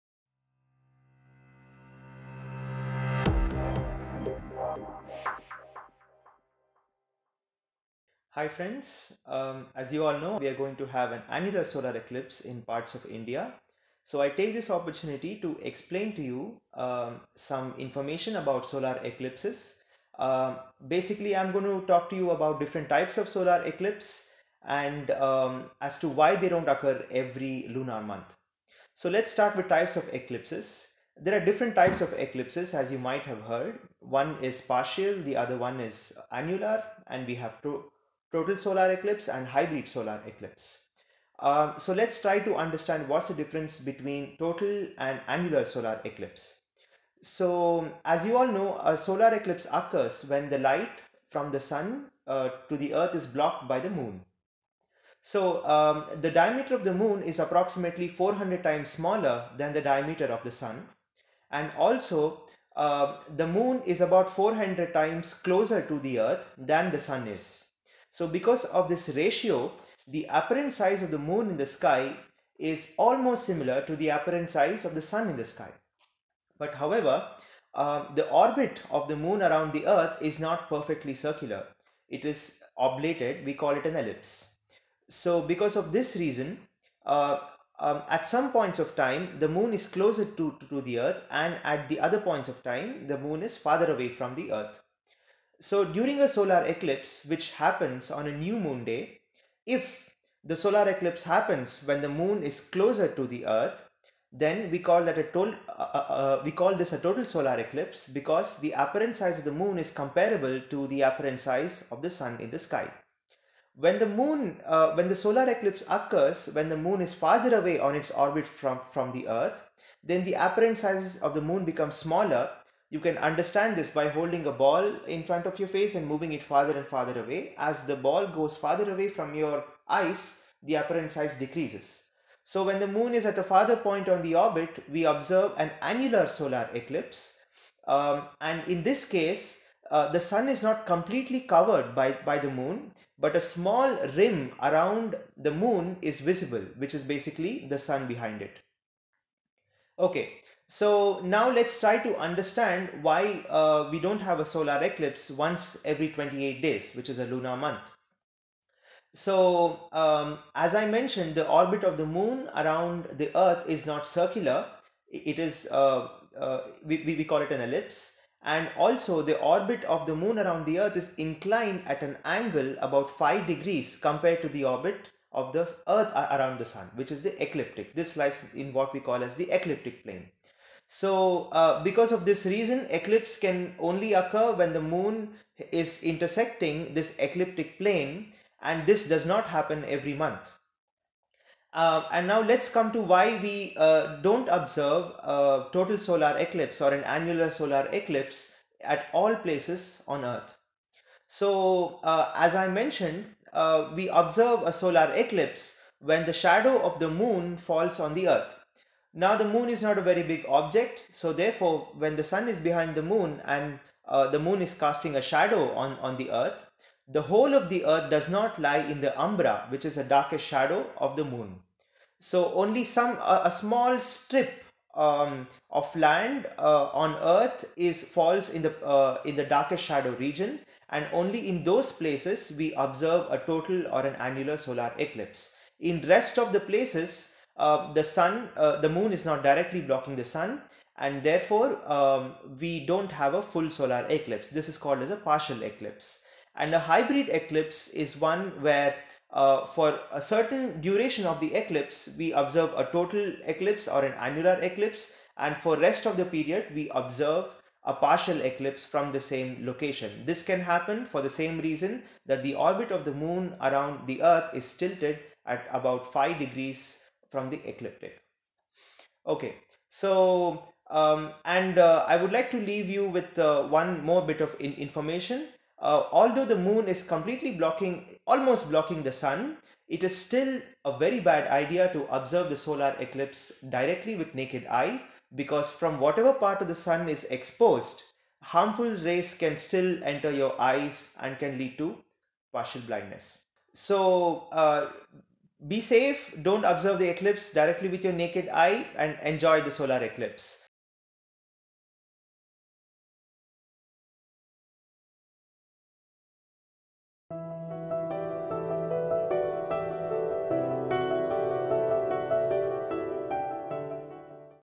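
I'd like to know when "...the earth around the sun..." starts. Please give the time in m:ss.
2:55.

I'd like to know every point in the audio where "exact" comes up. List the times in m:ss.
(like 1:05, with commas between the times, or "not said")
not said.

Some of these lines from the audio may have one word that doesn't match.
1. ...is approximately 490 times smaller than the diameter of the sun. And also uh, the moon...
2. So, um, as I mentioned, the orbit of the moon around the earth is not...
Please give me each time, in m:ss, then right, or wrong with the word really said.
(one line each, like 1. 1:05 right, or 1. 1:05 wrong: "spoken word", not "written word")
1. 0:57 wrong: "400", not "490"
2. 2:39 right.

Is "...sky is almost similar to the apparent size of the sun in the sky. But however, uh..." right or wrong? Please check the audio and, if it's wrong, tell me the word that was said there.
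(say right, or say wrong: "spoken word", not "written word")
right.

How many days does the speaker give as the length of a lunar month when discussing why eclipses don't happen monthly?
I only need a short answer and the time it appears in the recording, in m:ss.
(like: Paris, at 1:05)
28, at 2:36.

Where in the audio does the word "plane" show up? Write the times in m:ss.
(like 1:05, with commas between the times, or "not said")
3:00, 3:07.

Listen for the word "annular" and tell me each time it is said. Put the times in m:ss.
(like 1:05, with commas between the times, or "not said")
0:11, 0:36, 0:45, 2:15, 3:17, 3:54, 4:14.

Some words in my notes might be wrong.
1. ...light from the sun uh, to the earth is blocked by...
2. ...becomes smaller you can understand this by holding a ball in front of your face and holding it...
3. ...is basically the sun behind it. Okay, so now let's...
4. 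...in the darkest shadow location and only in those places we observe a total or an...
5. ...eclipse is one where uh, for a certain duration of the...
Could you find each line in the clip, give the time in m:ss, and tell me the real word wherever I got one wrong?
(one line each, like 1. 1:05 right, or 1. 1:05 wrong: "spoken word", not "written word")
1. 0:50 right
2. 2:01 wrong: "moving", not "holding"
3. 2:26 right
4. 3:49 wrong: "region", not "location"
5. 4:07 right.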